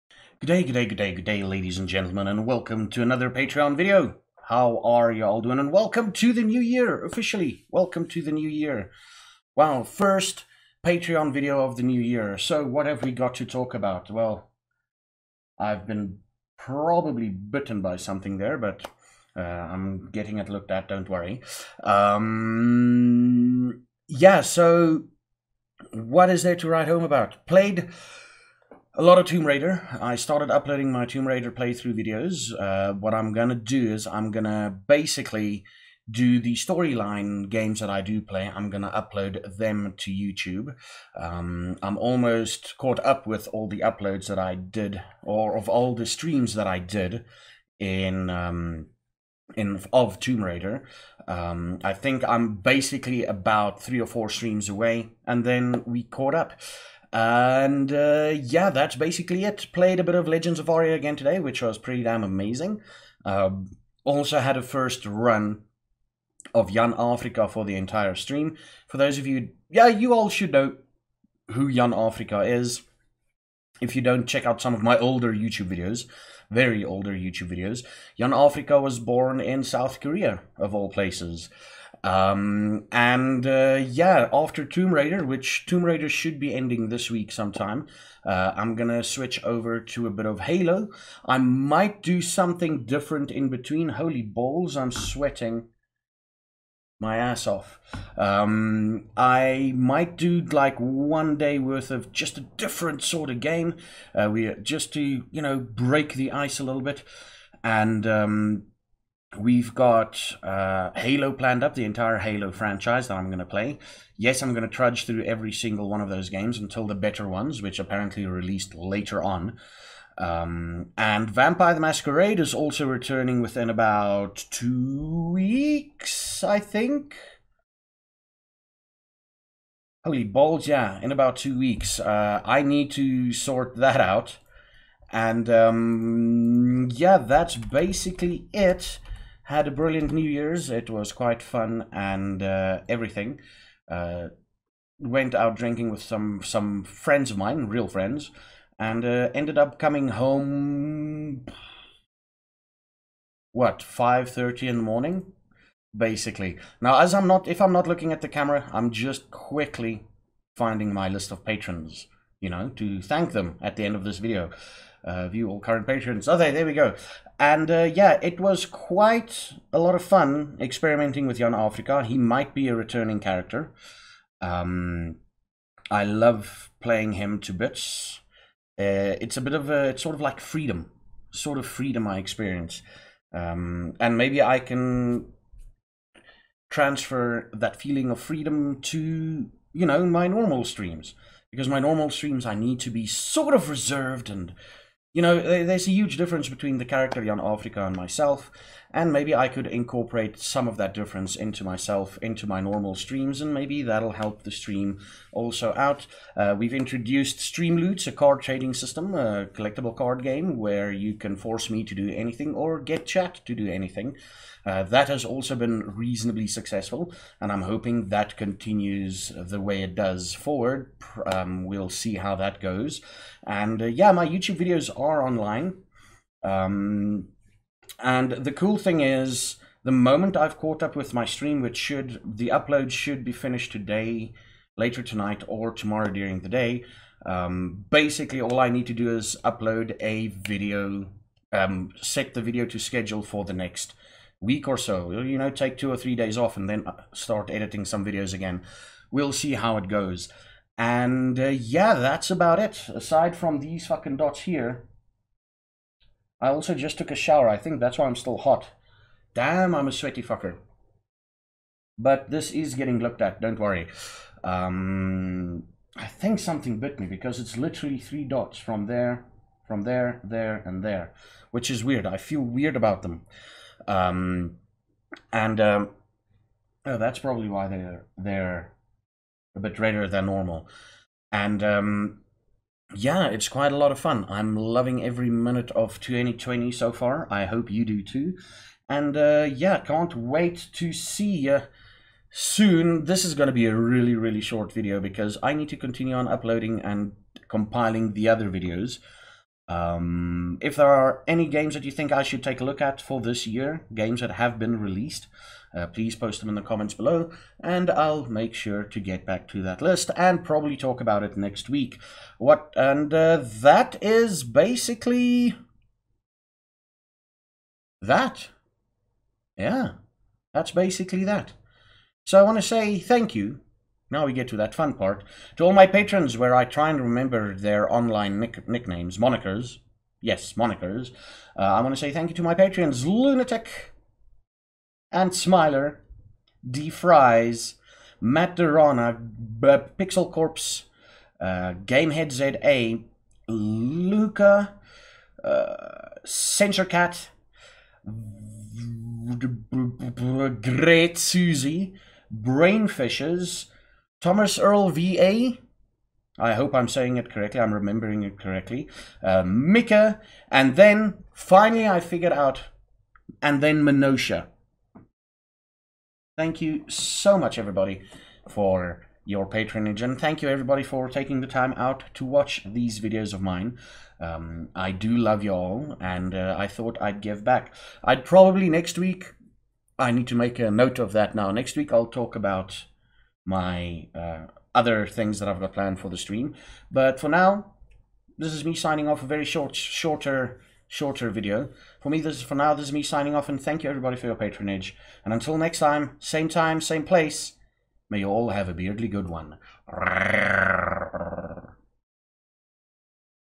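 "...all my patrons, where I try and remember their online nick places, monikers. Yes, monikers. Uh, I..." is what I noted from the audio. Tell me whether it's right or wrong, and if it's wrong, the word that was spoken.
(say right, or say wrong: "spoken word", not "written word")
wrong: "nicknames", not "places".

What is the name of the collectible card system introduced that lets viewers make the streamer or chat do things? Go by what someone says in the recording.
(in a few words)
Stream Loots.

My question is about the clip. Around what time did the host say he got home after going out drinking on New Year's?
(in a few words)
5:30 in the morning.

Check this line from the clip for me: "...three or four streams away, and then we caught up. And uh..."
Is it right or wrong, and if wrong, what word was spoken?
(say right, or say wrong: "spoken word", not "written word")
right.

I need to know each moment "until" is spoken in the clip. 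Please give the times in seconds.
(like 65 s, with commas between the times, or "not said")
116 s, 395 s.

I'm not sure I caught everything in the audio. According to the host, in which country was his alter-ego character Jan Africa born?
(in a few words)
South Korea.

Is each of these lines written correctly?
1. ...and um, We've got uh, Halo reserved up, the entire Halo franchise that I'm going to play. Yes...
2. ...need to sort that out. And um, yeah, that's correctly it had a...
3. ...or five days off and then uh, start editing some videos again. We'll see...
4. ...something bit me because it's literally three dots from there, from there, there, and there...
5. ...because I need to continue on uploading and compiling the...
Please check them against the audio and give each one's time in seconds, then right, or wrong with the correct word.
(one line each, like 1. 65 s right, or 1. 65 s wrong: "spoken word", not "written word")
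1. 107 s wrong: "planned", not "reserved"
2. 132 s wrong: "basically", not "correctly"
3. 245 s wrong: "three", not "five"
4. 266 s right
5. 294 s right.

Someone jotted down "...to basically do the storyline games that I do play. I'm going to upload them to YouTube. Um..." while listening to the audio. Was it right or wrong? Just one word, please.
right.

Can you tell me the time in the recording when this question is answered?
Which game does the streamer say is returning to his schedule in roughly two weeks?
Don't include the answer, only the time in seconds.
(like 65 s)
121 s.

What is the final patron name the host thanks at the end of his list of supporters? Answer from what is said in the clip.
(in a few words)
Minosha.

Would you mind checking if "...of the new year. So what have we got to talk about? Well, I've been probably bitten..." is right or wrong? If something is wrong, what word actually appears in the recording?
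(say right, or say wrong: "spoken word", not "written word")
right.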